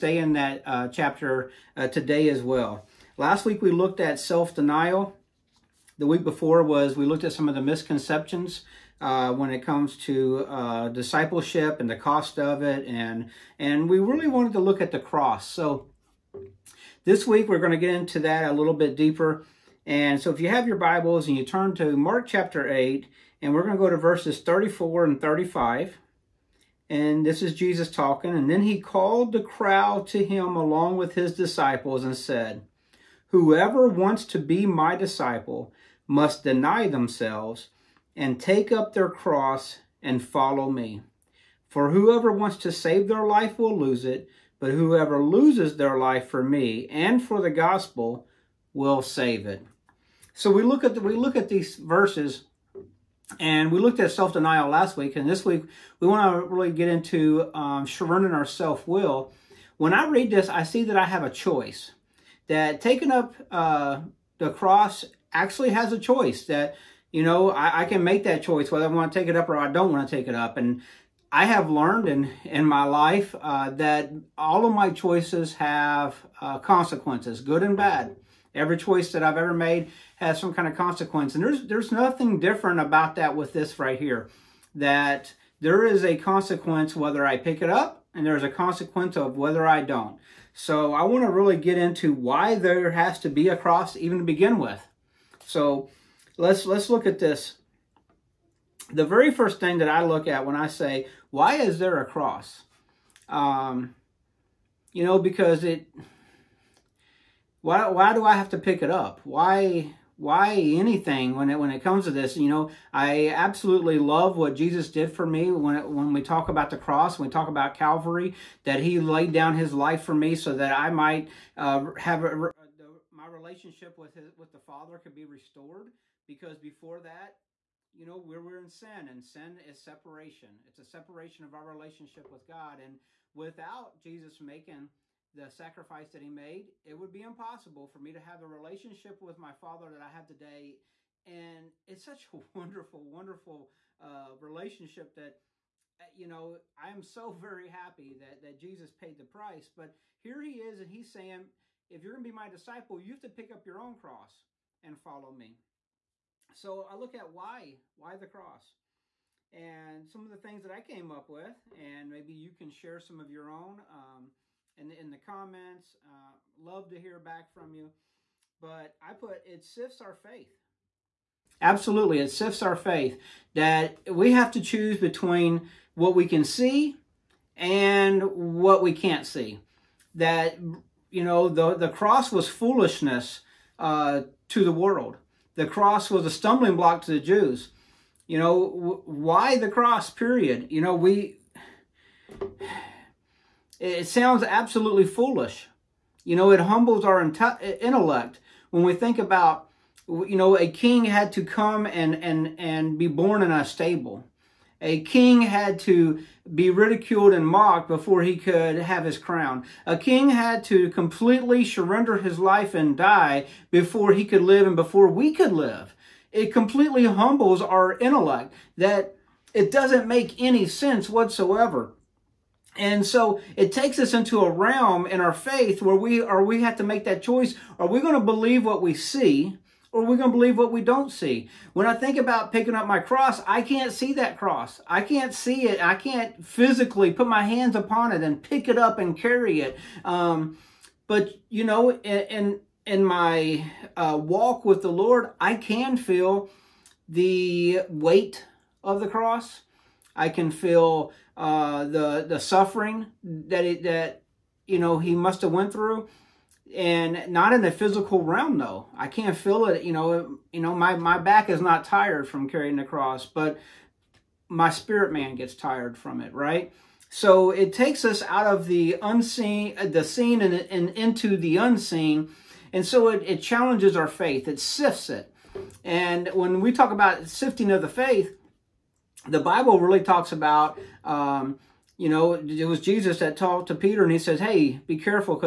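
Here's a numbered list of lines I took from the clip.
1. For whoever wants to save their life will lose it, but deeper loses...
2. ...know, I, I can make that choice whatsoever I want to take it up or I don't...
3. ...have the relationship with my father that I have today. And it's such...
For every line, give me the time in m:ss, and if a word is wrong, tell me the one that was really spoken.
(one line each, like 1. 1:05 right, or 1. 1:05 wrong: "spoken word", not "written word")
1. 0:41 wrong: "whoever", not "deeper"
2. 1:07 wrong: "whether", not "whatsoever"
3. 2:18 right.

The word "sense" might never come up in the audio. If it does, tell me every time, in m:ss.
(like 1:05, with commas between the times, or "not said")
3:40.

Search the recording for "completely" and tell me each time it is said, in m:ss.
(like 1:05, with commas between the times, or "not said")
3:30, 3:36.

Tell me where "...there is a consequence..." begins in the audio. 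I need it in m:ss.
1:25.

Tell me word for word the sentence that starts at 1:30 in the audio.
So I want to really get into why there has to be a cross even to begin with.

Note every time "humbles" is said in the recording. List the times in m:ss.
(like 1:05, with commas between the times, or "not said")
3:16, 3:37.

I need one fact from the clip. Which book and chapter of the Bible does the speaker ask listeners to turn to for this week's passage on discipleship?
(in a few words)
Mark 8.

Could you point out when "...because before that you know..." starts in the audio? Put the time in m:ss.
2:06.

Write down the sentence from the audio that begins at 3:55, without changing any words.
I can't physically put my hands upon it and pick it up and carry it.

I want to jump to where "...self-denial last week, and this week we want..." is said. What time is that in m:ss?
0:54.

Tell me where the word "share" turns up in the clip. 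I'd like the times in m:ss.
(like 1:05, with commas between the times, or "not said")
2:42.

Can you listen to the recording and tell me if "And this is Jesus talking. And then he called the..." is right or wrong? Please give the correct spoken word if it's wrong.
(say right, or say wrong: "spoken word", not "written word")
right.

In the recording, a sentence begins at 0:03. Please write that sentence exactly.
Last week we looked at self-denial.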